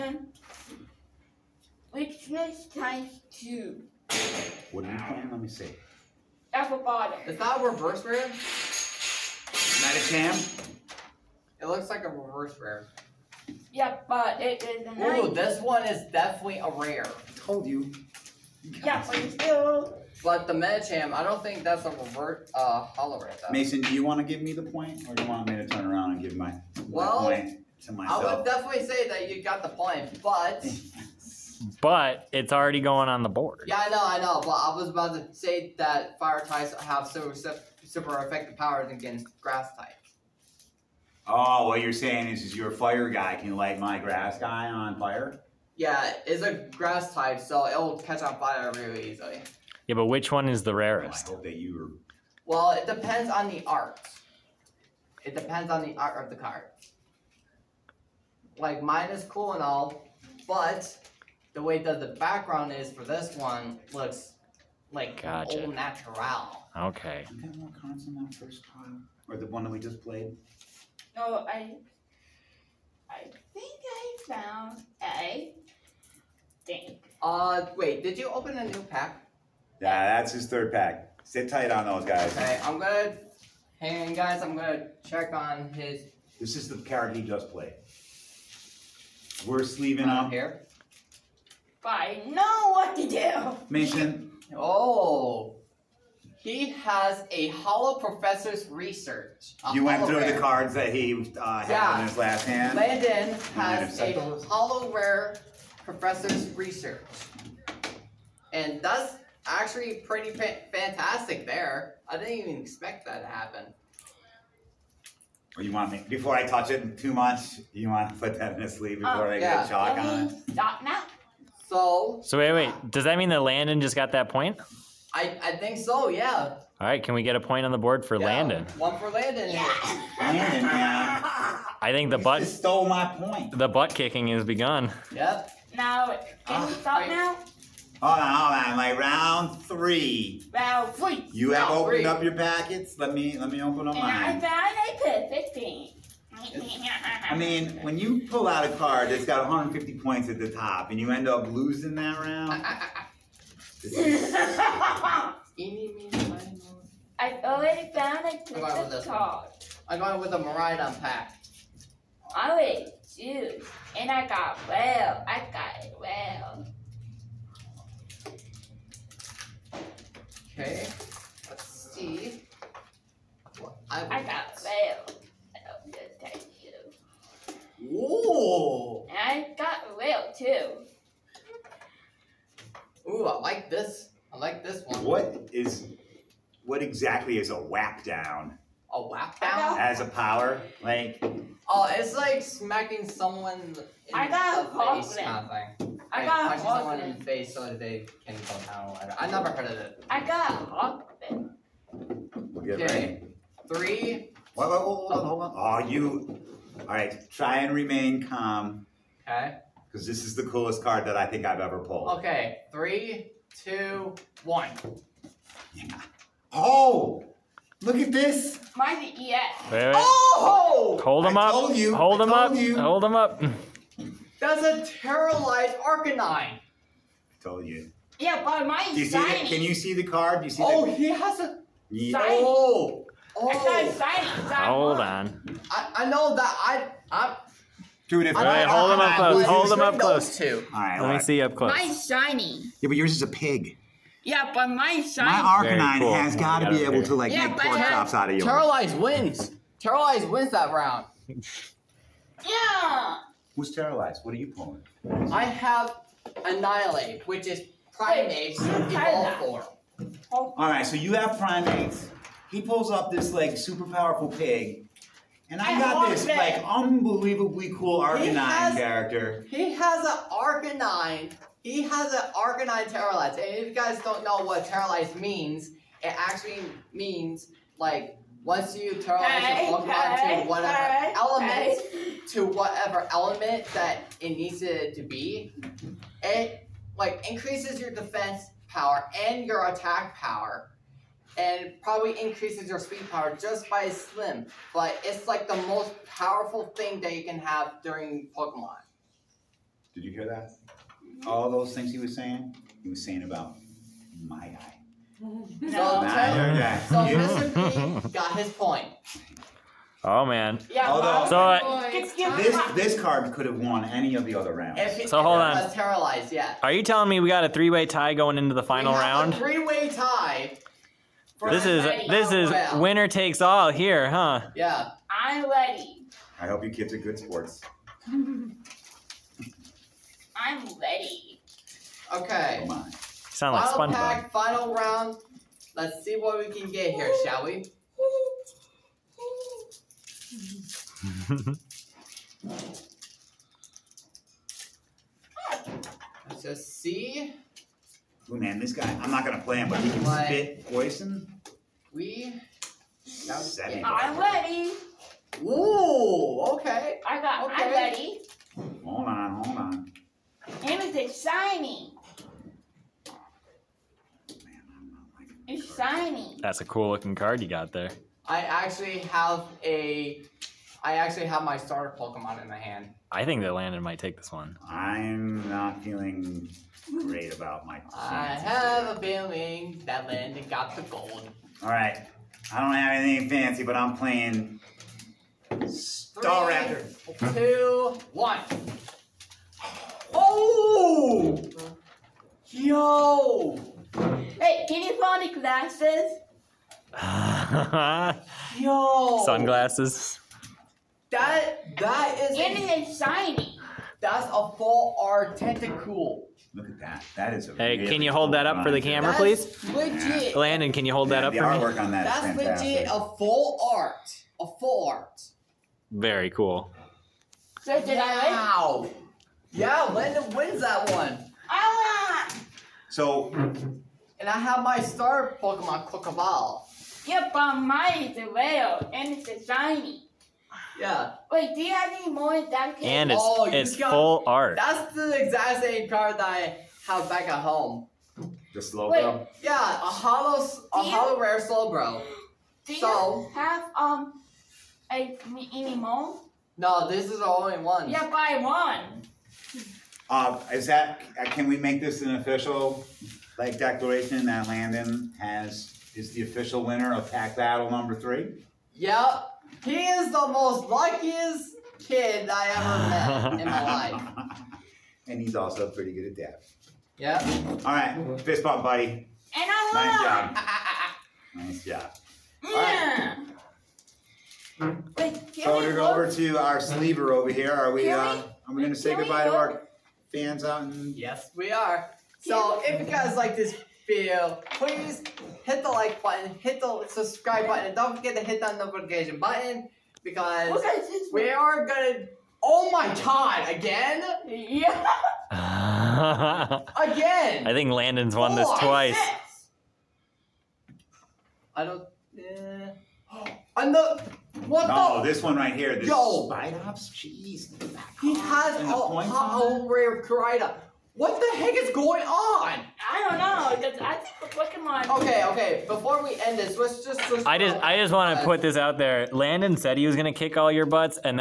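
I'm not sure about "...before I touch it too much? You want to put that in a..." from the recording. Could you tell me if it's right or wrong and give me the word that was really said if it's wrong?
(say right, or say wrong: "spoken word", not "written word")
right.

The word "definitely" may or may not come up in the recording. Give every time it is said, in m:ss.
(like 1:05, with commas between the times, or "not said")
0:16, 0:28.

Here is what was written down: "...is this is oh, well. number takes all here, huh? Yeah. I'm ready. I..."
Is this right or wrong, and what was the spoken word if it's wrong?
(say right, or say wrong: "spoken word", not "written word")
wrong: "winner", not "number".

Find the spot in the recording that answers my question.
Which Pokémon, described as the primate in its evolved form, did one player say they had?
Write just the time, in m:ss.
4:16.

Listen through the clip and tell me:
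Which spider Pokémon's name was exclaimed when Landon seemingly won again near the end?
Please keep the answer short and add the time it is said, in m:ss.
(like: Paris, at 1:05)
Spidops, at 8:26.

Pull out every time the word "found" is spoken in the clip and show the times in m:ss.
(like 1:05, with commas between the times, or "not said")
1:14, 2:24, 2:37.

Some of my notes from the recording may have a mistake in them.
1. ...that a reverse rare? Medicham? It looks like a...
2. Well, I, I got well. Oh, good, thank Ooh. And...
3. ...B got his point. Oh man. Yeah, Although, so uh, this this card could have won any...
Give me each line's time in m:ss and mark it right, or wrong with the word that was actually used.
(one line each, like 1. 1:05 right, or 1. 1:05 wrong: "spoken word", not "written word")
1. 0:07 right
2. 2:53 right
3. 5:08 right.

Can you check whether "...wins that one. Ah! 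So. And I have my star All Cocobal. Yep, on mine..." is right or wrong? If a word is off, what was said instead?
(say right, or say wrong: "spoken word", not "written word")
wrong: "Pokemon", not "All".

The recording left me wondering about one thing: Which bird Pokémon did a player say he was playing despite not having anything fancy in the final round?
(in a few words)
Staraptor.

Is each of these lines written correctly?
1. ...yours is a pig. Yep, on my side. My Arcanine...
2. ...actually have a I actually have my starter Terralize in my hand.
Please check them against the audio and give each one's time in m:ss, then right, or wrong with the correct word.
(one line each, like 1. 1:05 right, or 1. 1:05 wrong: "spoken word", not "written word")
1. 4:02 right
2. 6:08 wrong: "Pokemon", not "Terralize".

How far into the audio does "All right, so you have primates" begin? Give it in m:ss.
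4:20.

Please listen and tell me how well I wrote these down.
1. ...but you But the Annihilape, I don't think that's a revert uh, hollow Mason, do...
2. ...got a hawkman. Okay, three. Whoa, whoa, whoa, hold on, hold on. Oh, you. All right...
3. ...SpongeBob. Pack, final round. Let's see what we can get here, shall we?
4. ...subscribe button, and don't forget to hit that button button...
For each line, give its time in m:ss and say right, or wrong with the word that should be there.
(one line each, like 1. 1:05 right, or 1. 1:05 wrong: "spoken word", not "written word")
1. 0:19 wrong: "Medicham", not "Annihilape"
2. 3:20 right
3. 5:33 right
4. 8:06 wrong: "notification", not "button".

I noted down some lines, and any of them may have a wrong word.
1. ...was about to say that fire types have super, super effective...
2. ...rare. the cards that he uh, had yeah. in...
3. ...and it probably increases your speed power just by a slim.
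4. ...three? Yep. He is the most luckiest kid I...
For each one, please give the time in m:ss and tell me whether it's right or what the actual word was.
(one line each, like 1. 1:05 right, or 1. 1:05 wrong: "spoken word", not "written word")
1. 0:34 right
2. 1:40 right
3. 4:51 right
4. 7:37 right.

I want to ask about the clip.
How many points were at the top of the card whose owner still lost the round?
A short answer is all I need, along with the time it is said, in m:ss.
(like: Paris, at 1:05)
150, at 2:29.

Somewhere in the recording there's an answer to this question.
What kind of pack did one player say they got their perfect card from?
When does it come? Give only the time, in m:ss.
2:40.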